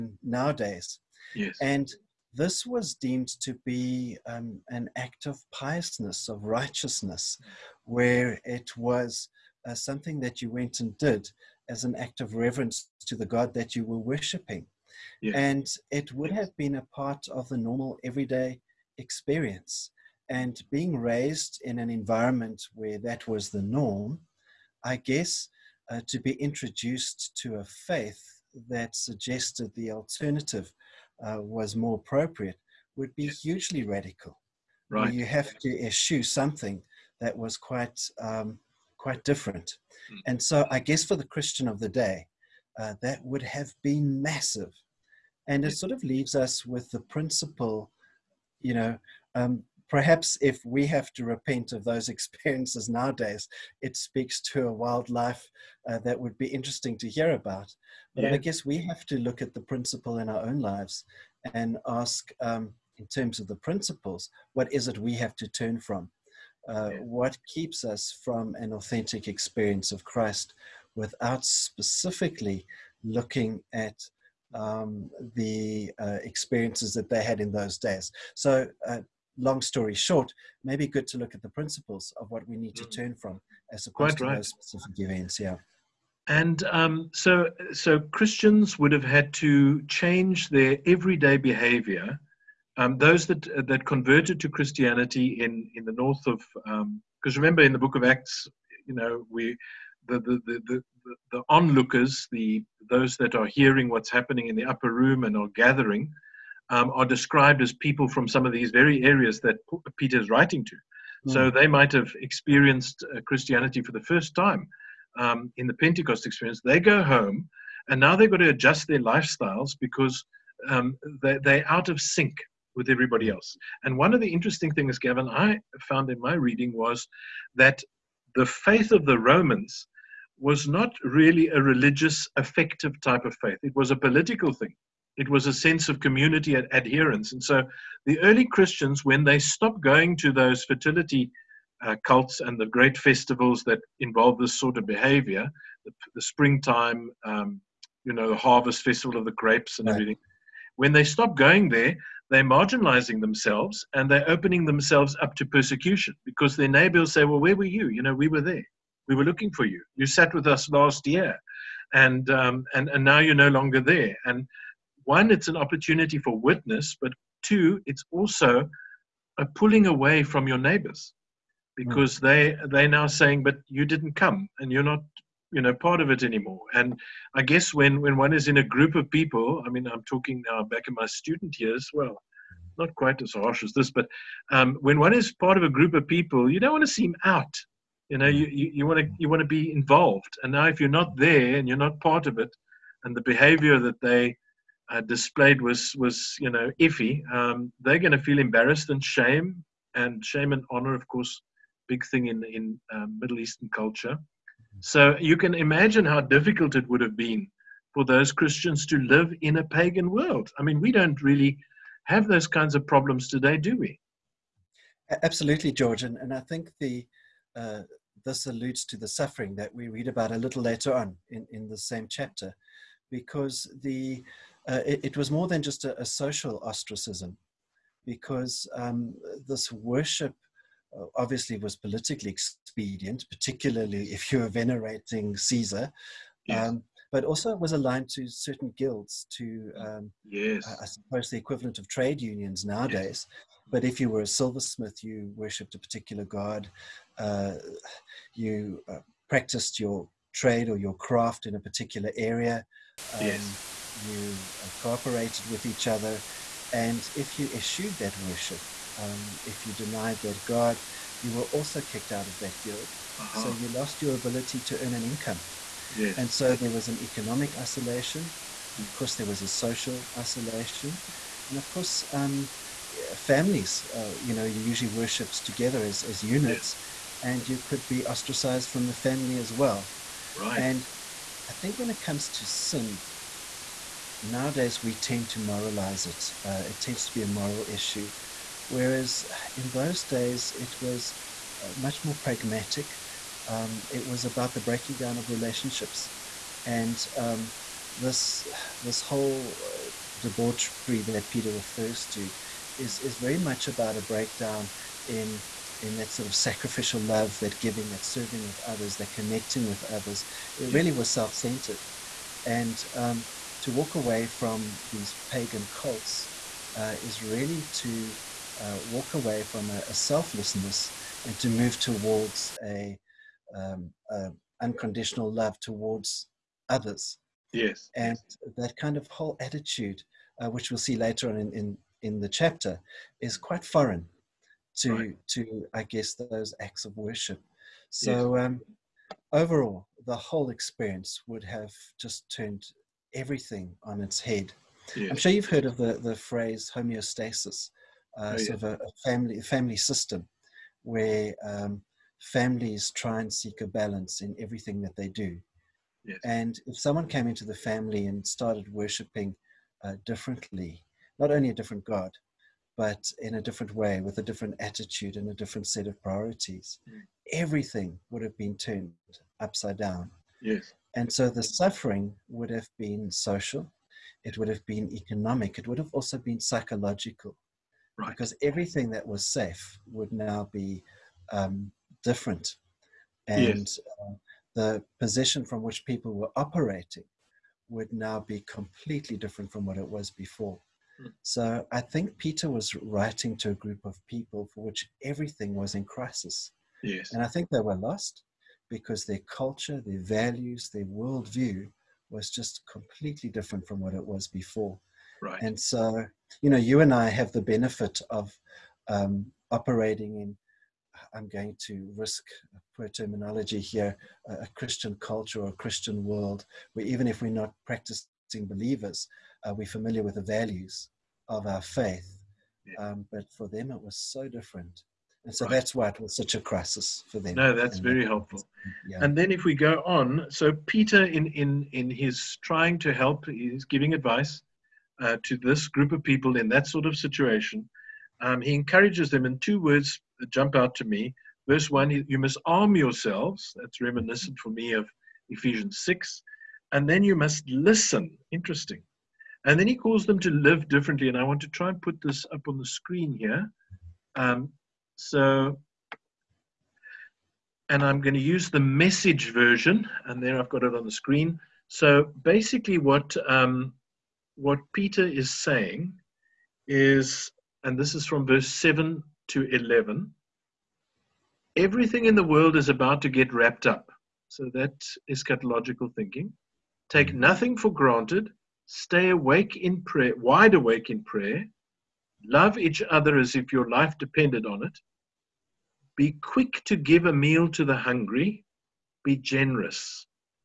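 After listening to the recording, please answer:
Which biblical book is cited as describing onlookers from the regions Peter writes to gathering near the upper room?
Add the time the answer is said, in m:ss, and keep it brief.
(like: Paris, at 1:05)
Book of Acts, at 1:37.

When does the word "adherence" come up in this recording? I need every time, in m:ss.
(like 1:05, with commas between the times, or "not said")
2:16.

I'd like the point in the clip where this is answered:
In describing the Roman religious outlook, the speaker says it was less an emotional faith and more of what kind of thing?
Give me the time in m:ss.
2:13.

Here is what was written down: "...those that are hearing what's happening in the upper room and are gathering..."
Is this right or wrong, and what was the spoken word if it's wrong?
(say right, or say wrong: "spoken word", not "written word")
right.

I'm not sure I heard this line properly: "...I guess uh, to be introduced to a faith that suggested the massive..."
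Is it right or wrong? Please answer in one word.
wrong.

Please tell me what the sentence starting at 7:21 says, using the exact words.
Verse 1 You must arm yourselves.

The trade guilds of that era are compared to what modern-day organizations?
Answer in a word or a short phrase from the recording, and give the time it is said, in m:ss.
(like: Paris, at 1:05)
Trade unions, at 4:01.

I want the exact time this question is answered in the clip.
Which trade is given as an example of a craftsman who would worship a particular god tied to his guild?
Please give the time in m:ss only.
4:04.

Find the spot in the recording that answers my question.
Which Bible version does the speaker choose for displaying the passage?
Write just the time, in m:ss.
7:38.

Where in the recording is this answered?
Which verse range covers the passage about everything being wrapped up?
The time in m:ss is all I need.
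7:48.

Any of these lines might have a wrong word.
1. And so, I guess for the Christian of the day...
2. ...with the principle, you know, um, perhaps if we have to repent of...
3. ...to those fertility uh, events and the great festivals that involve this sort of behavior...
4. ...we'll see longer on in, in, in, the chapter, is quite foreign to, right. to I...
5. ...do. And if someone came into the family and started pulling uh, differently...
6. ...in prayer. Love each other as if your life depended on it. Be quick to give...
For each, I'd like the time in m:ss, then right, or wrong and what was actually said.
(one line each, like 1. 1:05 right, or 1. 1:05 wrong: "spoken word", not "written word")
1. 0:40 right
2. 0:46 right
3. 2:20 wrong: "cults", not "events"
4. 5:30 wrong: "later", not "longer"
5. 5:55 wrong: "worshiping", not "pulling"
6. 8:00 right.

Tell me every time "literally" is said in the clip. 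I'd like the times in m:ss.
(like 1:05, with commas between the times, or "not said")
not said.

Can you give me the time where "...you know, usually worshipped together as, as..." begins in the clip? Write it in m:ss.
4:34.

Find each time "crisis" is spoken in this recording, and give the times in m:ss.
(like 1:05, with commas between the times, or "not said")
6:35, 7:06.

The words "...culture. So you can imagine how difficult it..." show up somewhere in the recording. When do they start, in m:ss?
3:23.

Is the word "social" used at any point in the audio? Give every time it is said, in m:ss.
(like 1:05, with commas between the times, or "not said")
3:46, 4:29, 6:13.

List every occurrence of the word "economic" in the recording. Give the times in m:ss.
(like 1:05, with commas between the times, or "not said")
4:26, 6:14.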